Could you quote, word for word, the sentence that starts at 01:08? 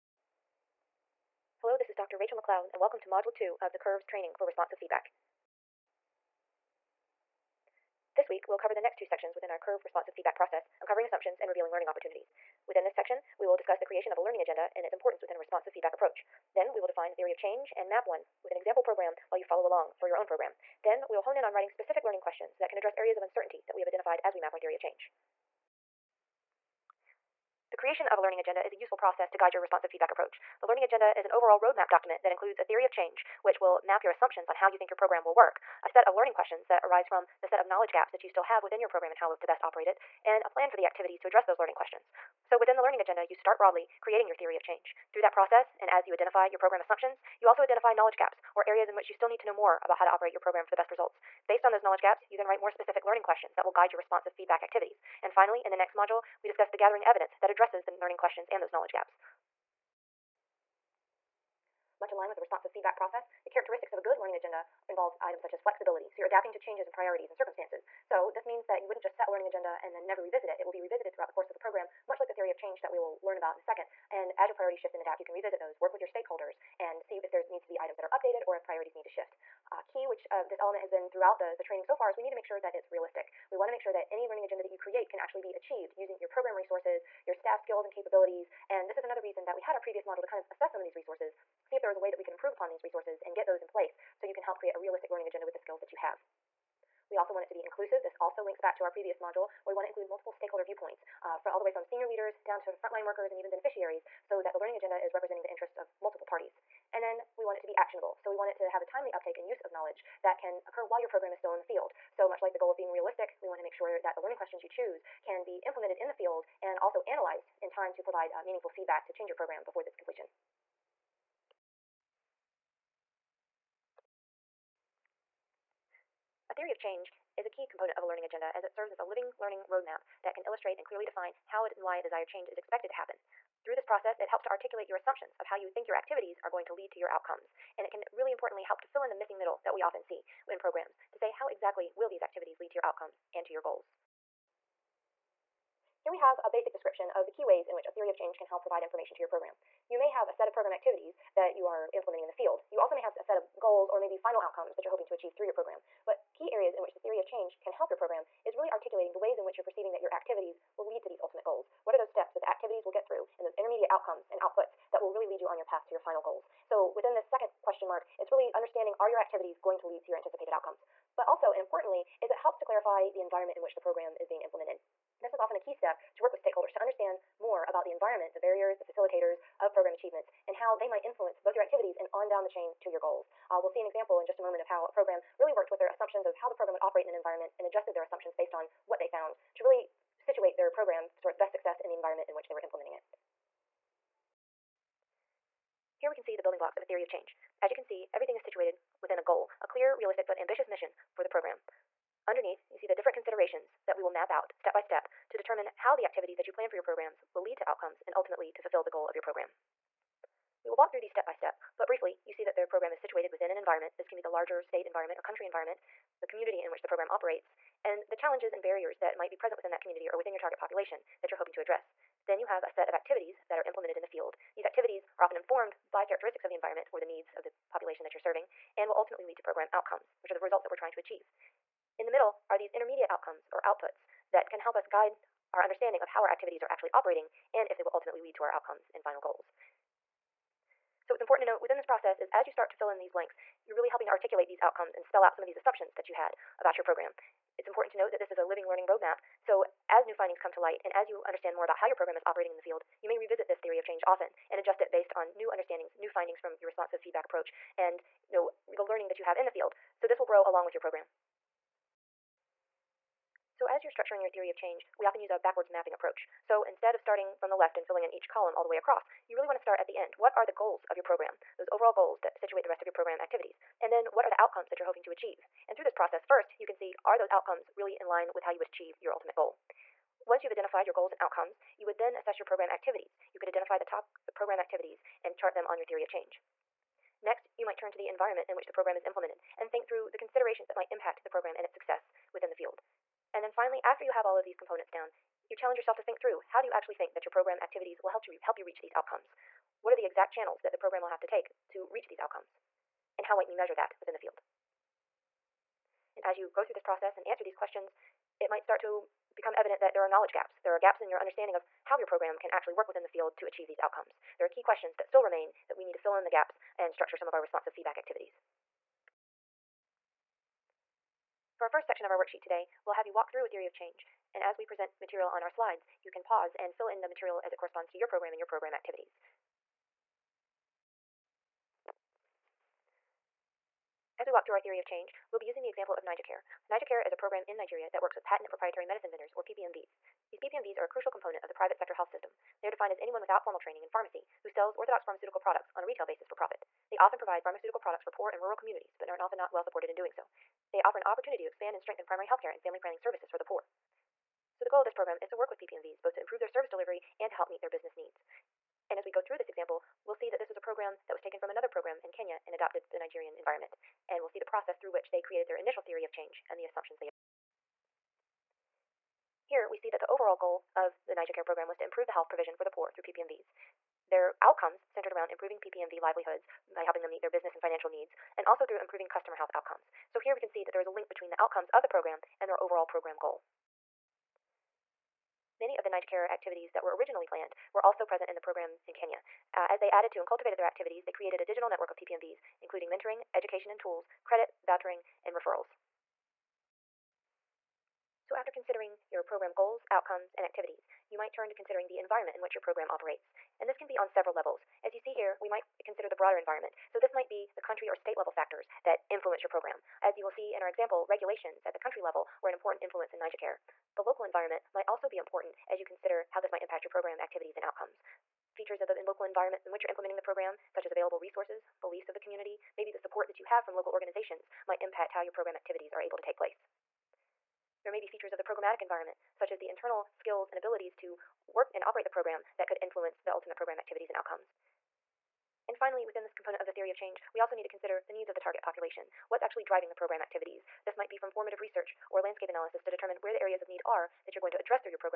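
So this means that you wouldn't just set a learning agenda and then never revisit it.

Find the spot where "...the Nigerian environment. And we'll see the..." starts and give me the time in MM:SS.
06:02.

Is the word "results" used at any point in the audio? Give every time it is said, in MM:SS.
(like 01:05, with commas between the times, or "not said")
00:50, 03:50.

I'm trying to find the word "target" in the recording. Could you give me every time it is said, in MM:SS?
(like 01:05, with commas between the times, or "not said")
03:40, 07:18.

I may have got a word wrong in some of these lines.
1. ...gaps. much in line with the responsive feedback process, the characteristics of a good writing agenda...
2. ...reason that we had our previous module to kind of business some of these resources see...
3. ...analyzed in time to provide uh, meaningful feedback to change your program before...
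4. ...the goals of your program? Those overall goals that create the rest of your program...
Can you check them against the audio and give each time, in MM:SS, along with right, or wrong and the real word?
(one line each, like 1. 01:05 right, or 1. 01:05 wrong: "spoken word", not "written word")
1. 00:58 wrong: "learning", not "writing"
2. 01:29 wrong: "assess", not "business"
3. 01:57 right
4. 04:30 wrong: "situate", not "create".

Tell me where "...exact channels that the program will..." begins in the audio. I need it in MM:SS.
05:00.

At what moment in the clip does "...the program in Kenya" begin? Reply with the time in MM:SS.
06:28.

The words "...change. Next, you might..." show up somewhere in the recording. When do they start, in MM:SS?
04:46.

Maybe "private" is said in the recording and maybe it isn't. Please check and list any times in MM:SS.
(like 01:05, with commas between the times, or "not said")
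05:41.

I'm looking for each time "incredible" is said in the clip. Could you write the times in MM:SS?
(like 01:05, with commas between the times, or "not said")
not said.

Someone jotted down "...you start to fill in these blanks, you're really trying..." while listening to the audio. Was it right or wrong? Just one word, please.
wrong.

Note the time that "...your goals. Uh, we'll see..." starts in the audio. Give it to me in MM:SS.
03:02.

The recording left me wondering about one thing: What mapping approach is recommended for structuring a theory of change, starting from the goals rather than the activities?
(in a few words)
backwards mapping.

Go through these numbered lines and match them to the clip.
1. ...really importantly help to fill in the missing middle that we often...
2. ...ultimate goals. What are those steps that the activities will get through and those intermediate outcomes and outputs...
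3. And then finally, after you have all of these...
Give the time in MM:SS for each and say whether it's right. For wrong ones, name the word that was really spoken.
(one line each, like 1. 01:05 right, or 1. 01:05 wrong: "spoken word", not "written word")
1. 02:18 right
2. 02:41 right
3. 04:53 right.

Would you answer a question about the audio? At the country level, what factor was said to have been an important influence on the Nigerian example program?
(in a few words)
regulations.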